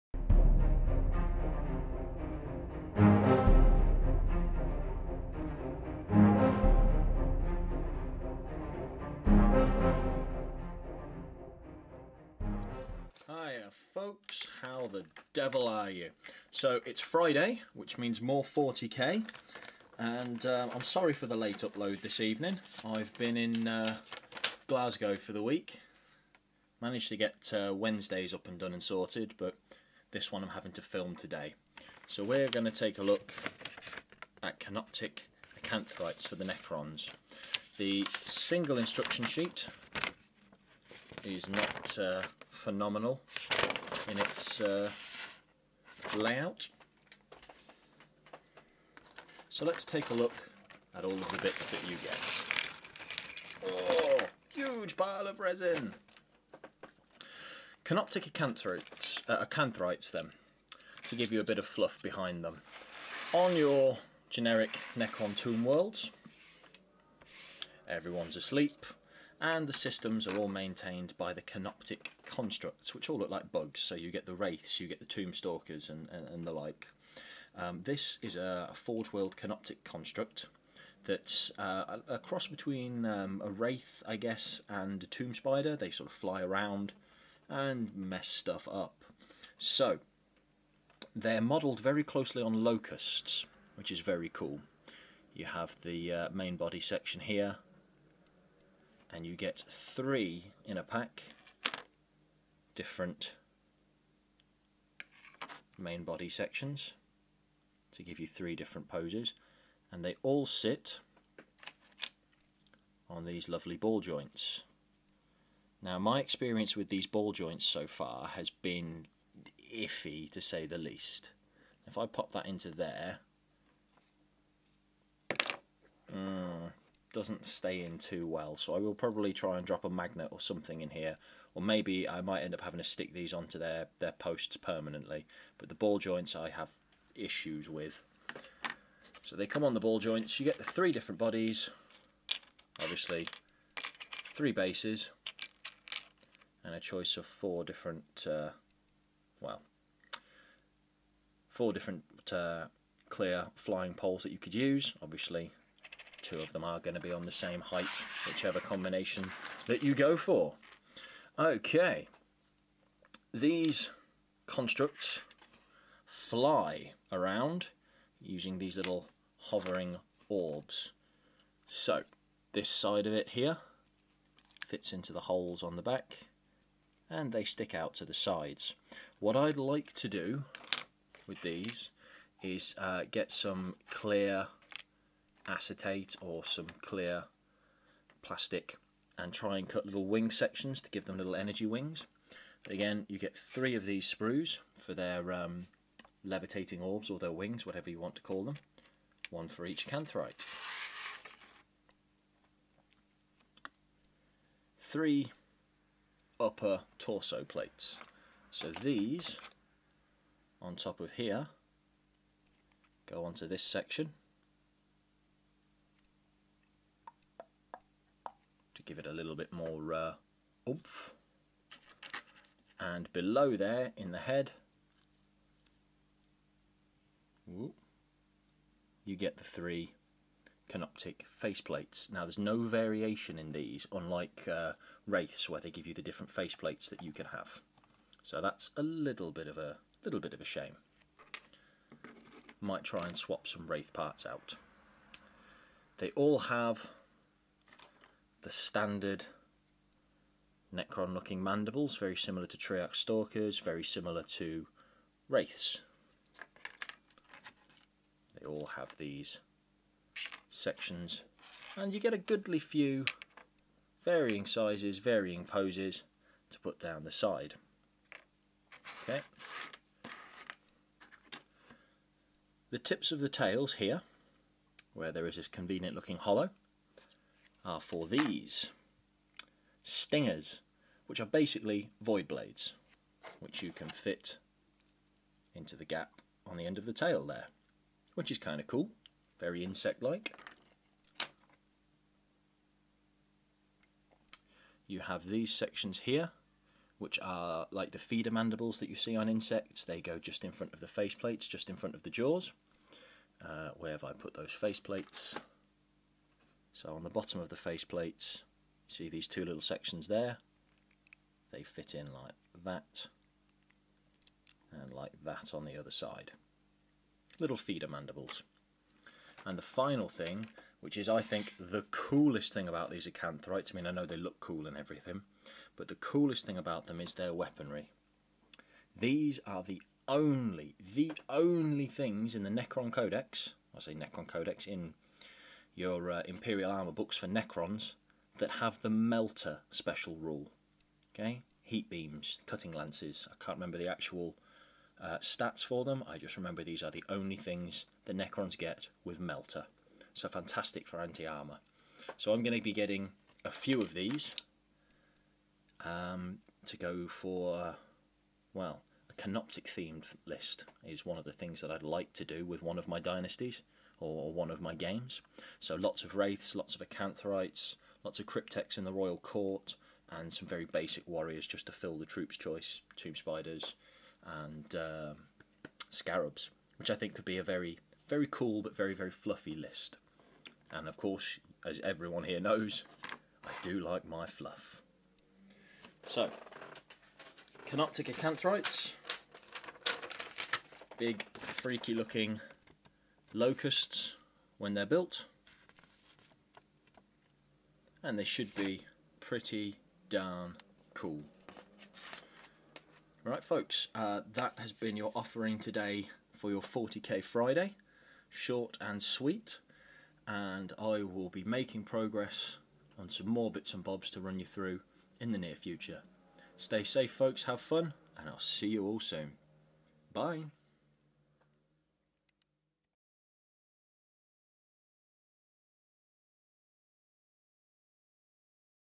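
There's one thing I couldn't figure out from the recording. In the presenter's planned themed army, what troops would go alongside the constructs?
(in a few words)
Basic warriors.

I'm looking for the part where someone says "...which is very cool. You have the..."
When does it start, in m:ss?
1:33.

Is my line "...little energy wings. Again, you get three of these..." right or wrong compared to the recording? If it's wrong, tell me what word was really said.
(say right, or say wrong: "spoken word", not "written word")
right.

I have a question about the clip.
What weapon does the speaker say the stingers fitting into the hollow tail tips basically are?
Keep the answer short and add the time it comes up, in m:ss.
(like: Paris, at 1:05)
Void blades, at 4:42.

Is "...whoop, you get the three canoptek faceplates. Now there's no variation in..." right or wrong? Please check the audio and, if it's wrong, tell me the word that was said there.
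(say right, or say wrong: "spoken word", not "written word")
right.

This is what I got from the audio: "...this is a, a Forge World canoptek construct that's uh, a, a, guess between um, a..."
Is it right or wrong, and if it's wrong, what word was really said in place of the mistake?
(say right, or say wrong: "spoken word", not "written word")
wrong: "cross", not "guess".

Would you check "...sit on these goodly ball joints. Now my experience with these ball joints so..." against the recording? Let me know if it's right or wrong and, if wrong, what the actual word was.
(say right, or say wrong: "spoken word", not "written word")
wrong: "lovely", not "goodly".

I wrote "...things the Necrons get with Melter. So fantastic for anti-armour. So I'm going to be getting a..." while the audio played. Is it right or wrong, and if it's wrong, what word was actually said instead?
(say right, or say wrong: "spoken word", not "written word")
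right.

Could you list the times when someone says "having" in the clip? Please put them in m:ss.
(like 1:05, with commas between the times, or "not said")
0:30, 2:12.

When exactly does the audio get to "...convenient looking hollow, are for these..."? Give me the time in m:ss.
4:35.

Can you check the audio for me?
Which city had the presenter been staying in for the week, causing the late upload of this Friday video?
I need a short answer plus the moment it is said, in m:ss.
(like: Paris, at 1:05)
Glasgow, at 0:24.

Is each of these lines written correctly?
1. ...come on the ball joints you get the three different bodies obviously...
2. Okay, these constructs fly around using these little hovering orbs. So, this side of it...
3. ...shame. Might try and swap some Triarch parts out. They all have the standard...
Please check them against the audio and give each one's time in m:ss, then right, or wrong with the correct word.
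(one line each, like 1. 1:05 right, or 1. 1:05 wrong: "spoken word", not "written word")
1. 2:19 right
2. 2:41 right
3. 4:00 wrong: "Wraith", not "Triarch".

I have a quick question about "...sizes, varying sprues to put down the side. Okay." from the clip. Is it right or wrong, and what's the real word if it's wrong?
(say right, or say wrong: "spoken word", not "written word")
wrong: "poses", not "sprues".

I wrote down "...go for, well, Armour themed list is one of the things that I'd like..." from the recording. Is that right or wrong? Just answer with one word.
wrong.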